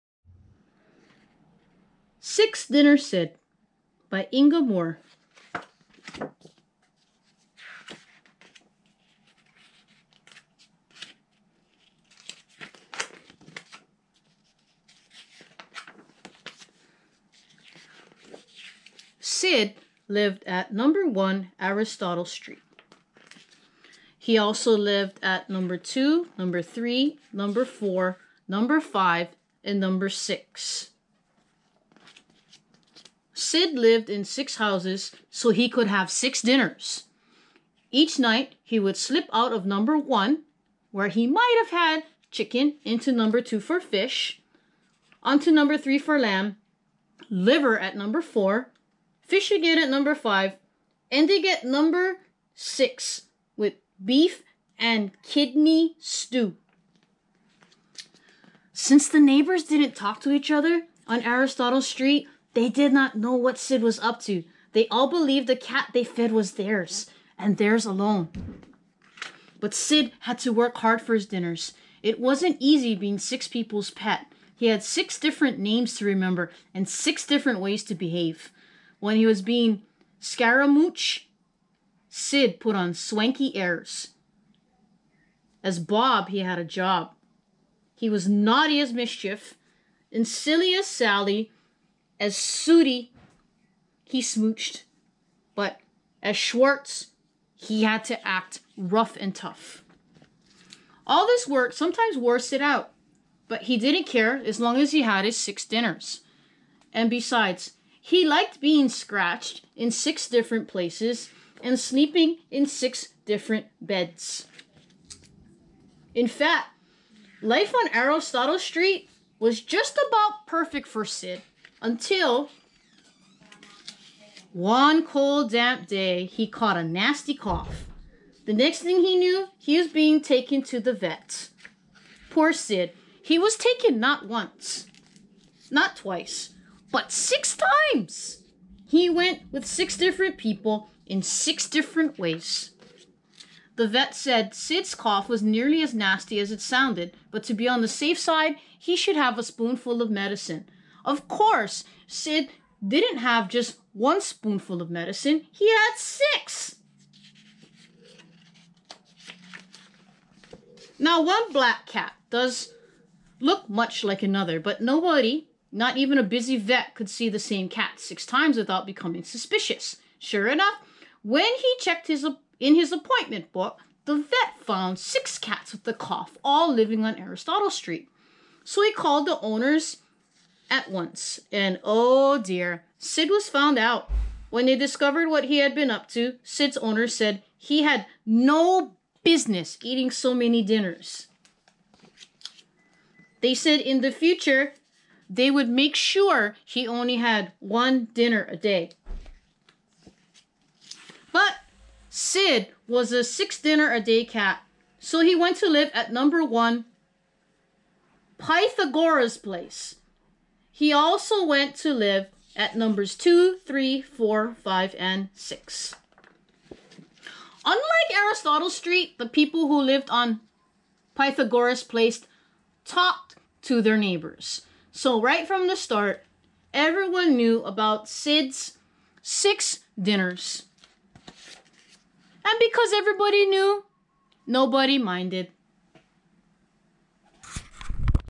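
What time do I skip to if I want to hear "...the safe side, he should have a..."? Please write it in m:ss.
2:27.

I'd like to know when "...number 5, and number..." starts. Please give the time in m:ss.
0:28.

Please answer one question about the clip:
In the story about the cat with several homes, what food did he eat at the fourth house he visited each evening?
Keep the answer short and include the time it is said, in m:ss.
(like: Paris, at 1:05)
Liver, at 0:47.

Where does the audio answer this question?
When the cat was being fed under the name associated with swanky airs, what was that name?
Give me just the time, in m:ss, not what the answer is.
1:20.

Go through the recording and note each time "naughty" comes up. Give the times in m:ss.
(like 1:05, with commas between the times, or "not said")
1:28.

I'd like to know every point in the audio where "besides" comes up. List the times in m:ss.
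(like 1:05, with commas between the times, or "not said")
1:47.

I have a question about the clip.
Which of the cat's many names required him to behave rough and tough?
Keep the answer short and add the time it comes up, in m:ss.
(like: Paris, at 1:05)
Schwartz, at 1:36.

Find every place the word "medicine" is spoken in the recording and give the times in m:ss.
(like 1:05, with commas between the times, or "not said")
2:30, 2:34.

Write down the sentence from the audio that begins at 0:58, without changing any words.
Since the neighbors didn't talk to each other on Aristotle Street, they did not know what Sid was up to.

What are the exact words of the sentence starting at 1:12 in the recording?
It wasn't easy being six people's pet.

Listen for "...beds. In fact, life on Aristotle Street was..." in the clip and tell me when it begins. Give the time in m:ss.
1:53.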